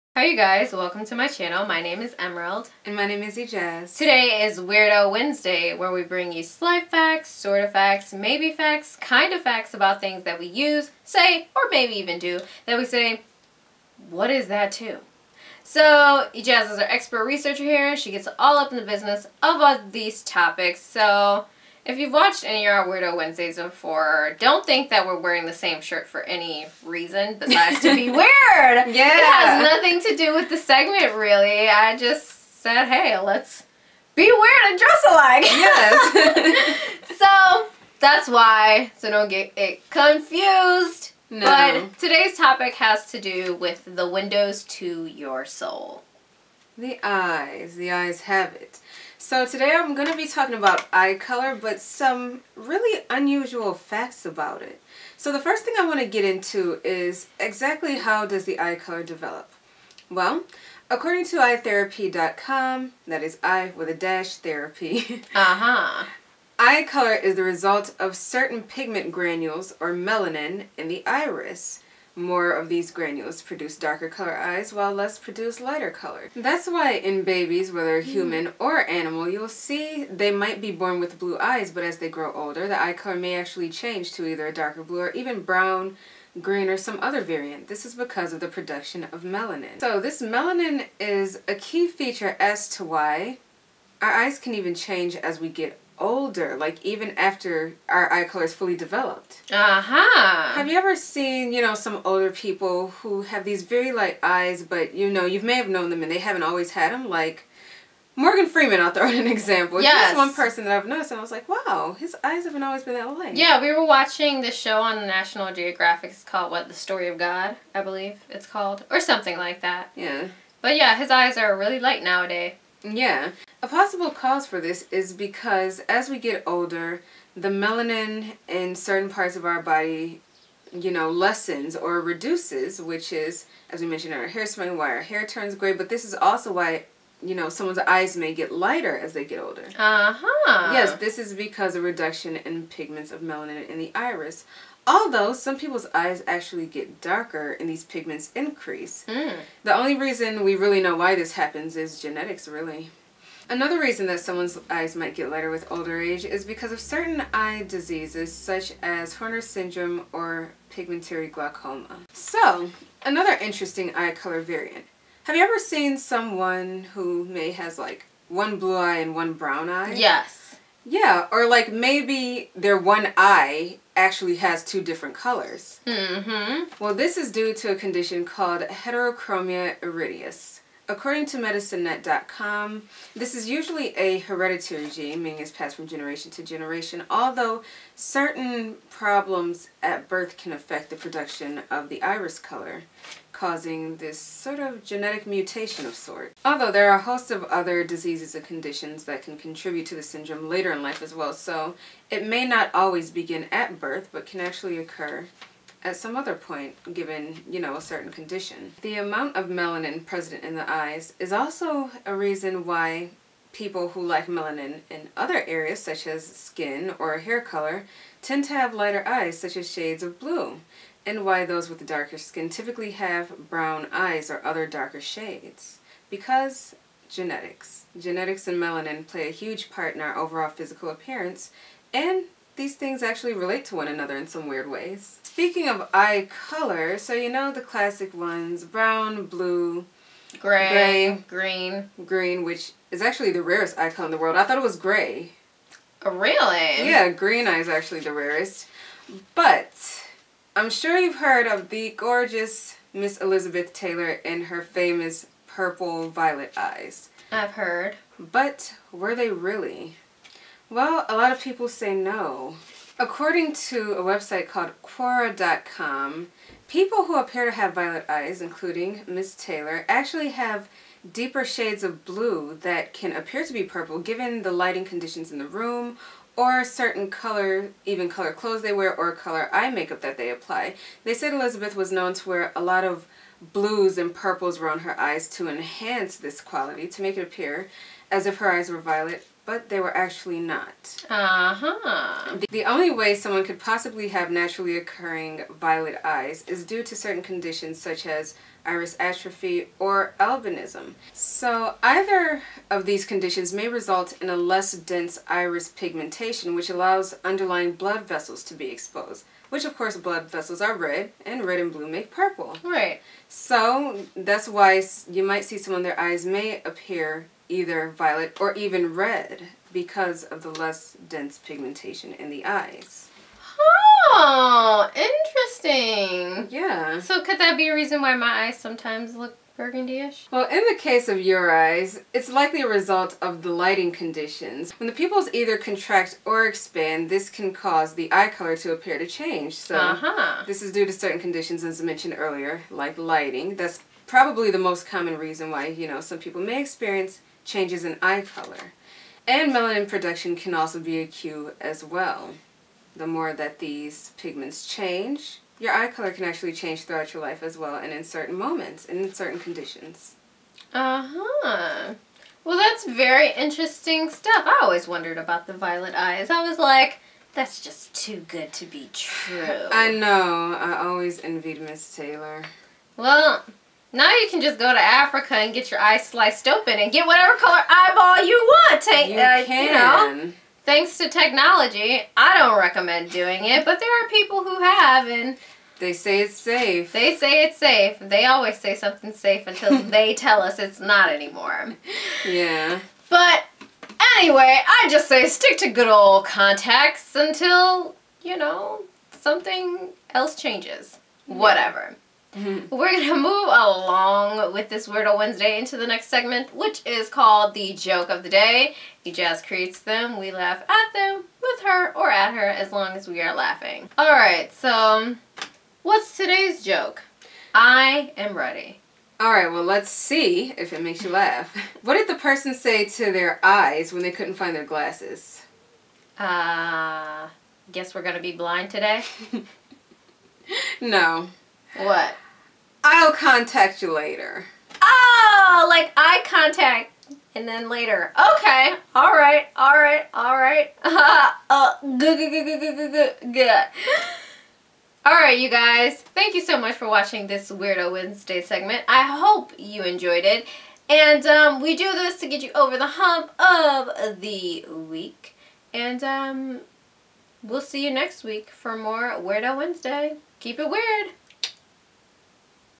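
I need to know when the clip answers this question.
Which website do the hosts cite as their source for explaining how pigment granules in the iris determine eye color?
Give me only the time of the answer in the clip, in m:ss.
1:01.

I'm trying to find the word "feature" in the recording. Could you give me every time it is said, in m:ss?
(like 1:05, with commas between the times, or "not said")
1:31.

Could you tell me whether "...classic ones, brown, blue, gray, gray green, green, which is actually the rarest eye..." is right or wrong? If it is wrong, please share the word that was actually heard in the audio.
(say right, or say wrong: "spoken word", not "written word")
right.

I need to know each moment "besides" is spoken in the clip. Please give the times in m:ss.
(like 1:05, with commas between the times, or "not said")
0:27.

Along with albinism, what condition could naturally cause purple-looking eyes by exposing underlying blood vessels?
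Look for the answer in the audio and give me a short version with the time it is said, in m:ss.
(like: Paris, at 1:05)
iris atrophy, at 4:58.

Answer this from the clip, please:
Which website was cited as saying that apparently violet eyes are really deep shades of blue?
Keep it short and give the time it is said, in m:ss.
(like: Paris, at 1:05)
Quora.com, at 4:24.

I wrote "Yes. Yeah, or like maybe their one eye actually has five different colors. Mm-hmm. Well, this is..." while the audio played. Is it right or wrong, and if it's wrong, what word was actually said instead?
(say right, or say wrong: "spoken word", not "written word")
wrong: "two", not "five".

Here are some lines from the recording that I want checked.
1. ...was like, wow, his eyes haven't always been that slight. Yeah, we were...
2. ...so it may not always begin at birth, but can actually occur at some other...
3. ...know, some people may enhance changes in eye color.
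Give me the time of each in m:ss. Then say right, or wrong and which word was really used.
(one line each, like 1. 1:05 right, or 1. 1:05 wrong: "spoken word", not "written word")
1. 1:51 wrong: "light", not "slight"
2. 3:21 right
3. 5:45 wrong: "experience", not "enhance".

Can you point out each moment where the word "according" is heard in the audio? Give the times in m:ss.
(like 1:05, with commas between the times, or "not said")
1:00, 3:00, 4:22.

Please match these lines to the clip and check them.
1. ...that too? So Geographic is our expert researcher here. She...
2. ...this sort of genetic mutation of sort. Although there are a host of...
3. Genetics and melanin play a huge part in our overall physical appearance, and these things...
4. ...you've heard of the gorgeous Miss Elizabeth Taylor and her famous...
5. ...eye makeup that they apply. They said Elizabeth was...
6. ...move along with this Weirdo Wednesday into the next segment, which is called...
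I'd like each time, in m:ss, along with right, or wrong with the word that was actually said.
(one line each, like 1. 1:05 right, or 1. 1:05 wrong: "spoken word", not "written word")
1. 0:14 wrong: "Ejaz", not "Geographic"
2. 3:13 right
3. 3:47 right
4. 4:10 right
5. 4:39 right
6. 6:43 right.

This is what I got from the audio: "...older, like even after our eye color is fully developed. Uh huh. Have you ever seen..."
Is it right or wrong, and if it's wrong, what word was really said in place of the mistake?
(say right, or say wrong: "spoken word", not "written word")
right.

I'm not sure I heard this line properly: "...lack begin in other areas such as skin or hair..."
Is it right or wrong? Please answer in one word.
wrong.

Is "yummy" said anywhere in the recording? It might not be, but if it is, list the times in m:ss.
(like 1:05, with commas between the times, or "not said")
not said.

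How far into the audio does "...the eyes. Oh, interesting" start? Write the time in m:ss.
5:22.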